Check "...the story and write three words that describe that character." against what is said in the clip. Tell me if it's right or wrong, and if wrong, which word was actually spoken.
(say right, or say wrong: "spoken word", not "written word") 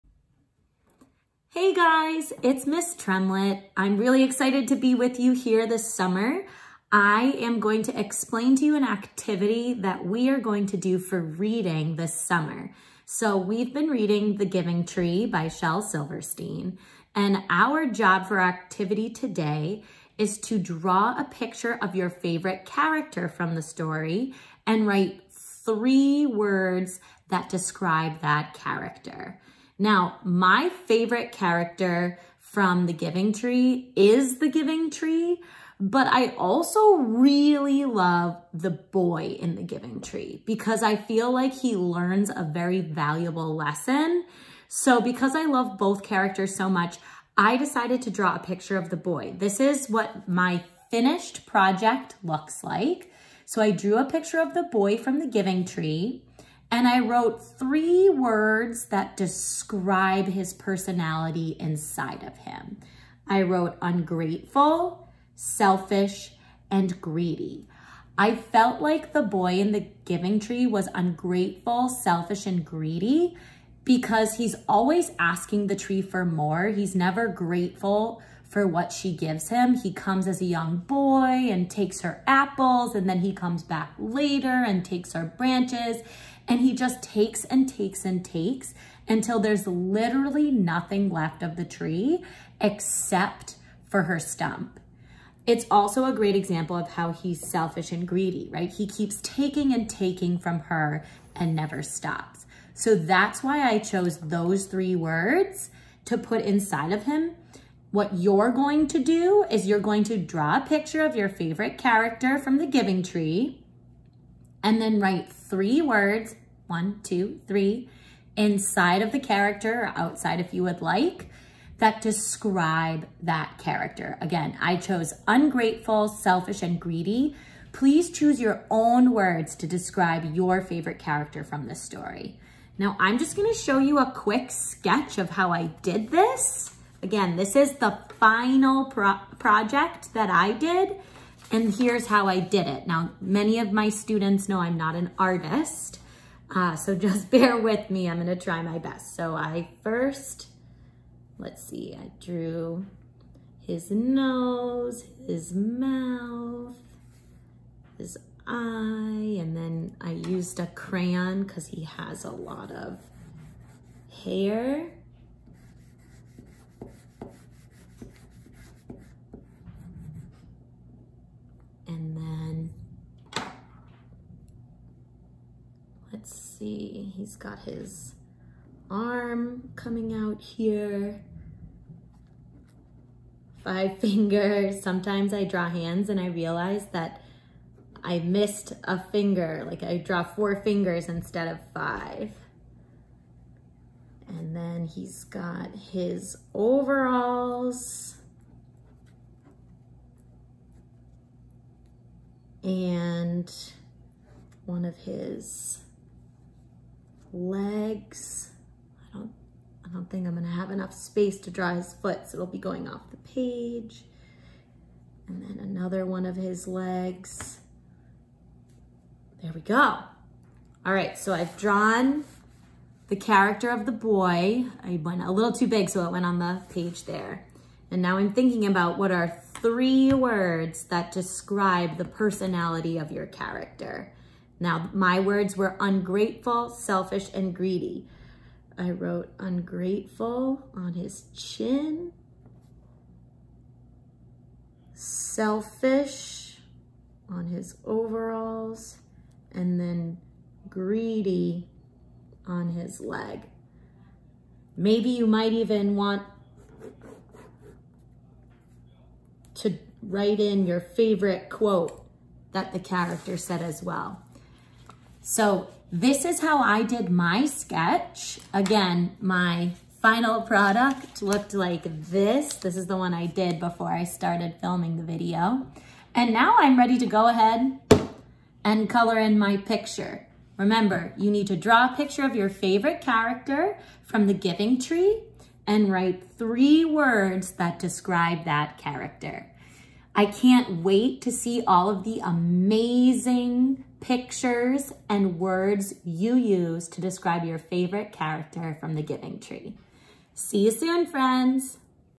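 right.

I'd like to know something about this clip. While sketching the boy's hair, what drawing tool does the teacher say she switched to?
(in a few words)
crayon.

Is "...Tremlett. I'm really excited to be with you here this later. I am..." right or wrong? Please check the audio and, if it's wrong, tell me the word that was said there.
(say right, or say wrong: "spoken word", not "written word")
wrong: "summer", not "later".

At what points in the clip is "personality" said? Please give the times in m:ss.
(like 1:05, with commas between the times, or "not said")
1:00, 3:52.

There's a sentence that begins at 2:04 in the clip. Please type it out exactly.
Again, I chose ungrateful, selfish, and greedy.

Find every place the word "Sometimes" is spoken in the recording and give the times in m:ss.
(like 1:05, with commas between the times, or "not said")
3:04.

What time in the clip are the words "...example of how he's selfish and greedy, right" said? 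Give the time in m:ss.
1:36.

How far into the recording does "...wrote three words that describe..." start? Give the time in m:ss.
0:56.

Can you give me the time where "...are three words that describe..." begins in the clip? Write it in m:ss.
3:49.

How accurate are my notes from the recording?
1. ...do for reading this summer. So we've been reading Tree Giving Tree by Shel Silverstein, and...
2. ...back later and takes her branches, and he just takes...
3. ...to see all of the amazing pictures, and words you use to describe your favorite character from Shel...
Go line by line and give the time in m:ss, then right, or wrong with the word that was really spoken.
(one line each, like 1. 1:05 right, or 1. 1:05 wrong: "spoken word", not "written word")
1. 0:10 wrong: "The", not "Tree"
2. 1:23 right
3. 4:51 wrong: "The", not "Shel".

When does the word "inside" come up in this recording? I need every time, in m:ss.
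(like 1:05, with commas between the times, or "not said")
1:01, 1:46, 1:58.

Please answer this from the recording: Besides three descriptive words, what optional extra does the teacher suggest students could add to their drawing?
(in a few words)
favorite quote.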